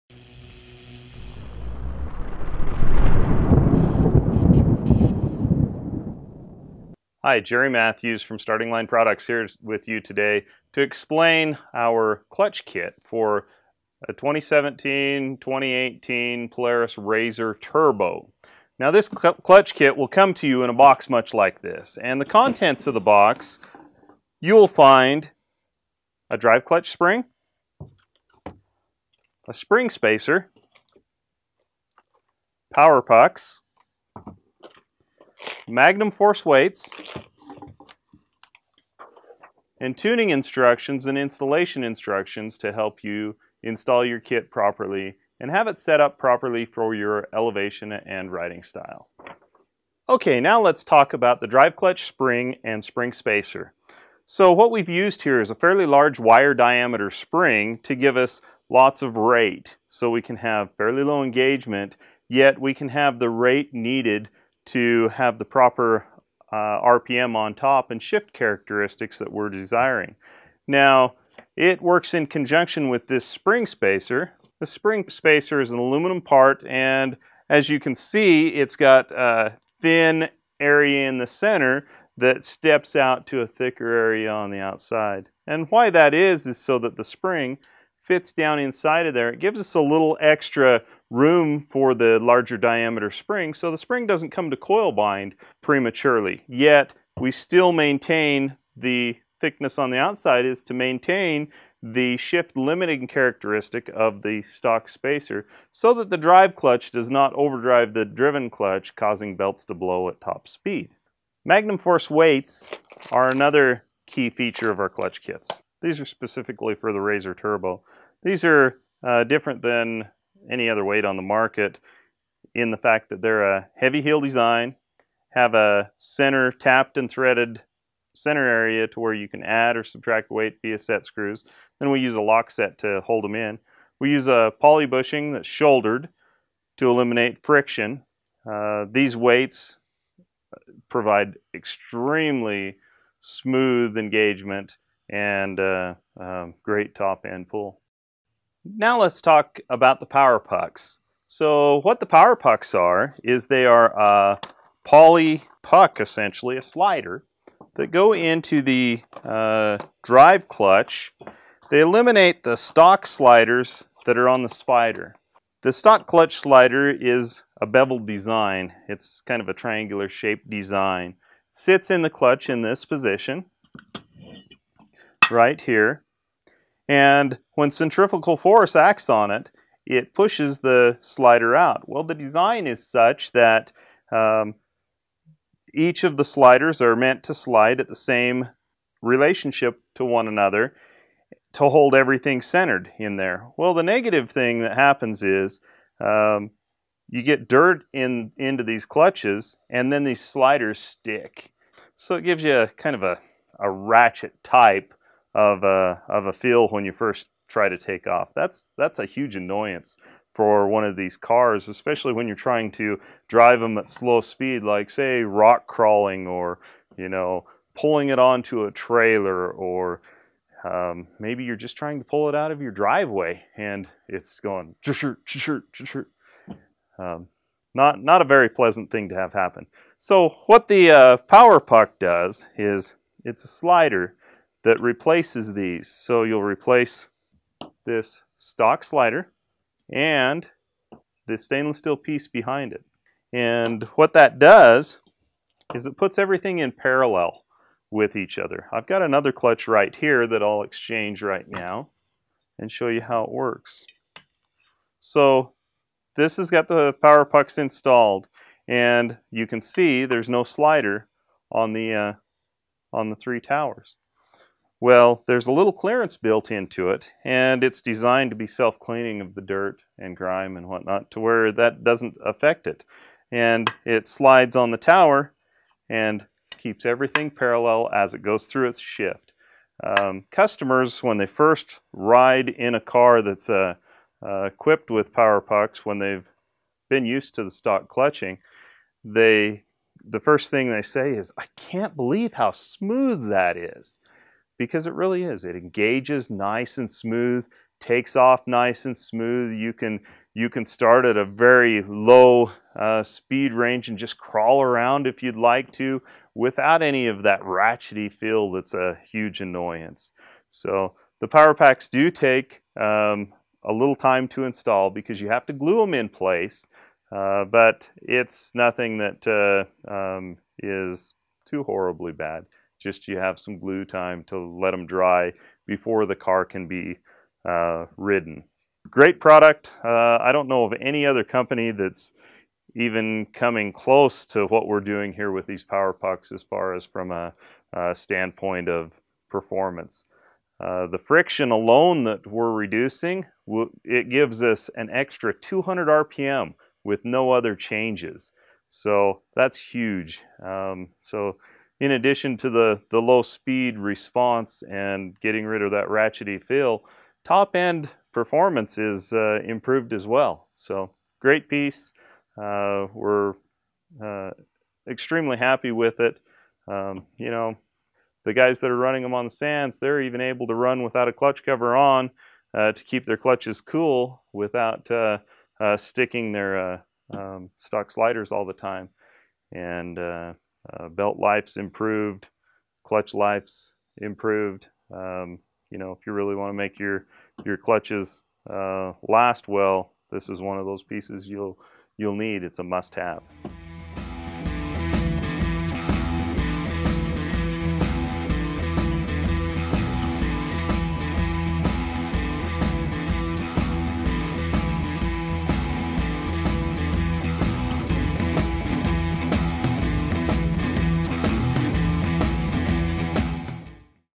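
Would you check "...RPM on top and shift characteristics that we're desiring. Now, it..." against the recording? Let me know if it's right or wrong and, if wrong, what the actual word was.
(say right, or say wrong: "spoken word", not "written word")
right.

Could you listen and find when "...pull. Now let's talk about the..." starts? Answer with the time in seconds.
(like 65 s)
147 s.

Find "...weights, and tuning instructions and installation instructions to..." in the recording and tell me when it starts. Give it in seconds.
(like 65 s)
36 s.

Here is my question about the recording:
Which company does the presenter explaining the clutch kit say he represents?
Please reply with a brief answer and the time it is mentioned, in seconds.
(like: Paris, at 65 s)
Starting Line Products, at 8 s.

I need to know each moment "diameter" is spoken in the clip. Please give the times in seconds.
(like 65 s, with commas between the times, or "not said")
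56 s, 92 s.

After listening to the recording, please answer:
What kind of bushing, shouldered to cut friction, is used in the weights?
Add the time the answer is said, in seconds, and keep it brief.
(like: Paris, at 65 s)
Poly bushing, at 134 s.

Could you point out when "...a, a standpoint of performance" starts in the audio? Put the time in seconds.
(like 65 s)
337 s.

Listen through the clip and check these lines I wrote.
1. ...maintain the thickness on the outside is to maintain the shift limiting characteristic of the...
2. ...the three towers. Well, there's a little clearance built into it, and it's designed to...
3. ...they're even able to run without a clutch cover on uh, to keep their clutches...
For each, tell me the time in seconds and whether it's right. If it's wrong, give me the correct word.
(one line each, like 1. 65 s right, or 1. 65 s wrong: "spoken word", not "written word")
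1. 97 s right
2. 263 s right
3. 369 s right.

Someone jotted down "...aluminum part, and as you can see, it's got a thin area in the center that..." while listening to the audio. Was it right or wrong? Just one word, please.
right.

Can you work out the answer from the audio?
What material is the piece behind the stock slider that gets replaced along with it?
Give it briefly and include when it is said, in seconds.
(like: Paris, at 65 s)
Stainless steel, at 241 s.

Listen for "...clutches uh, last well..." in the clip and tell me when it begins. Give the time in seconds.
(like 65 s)
387 s.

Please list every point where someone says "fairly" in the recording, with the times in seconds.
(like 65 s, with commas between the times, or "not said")
55 s, 60 s.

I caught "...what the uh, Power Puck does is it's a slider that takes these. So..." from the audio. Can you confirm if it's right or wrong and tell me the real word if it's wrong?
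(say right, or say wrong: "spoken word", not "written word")
wrong: "replaces", not "takes".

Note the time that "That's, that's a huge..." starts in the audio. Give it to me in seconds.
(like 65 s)
208 s.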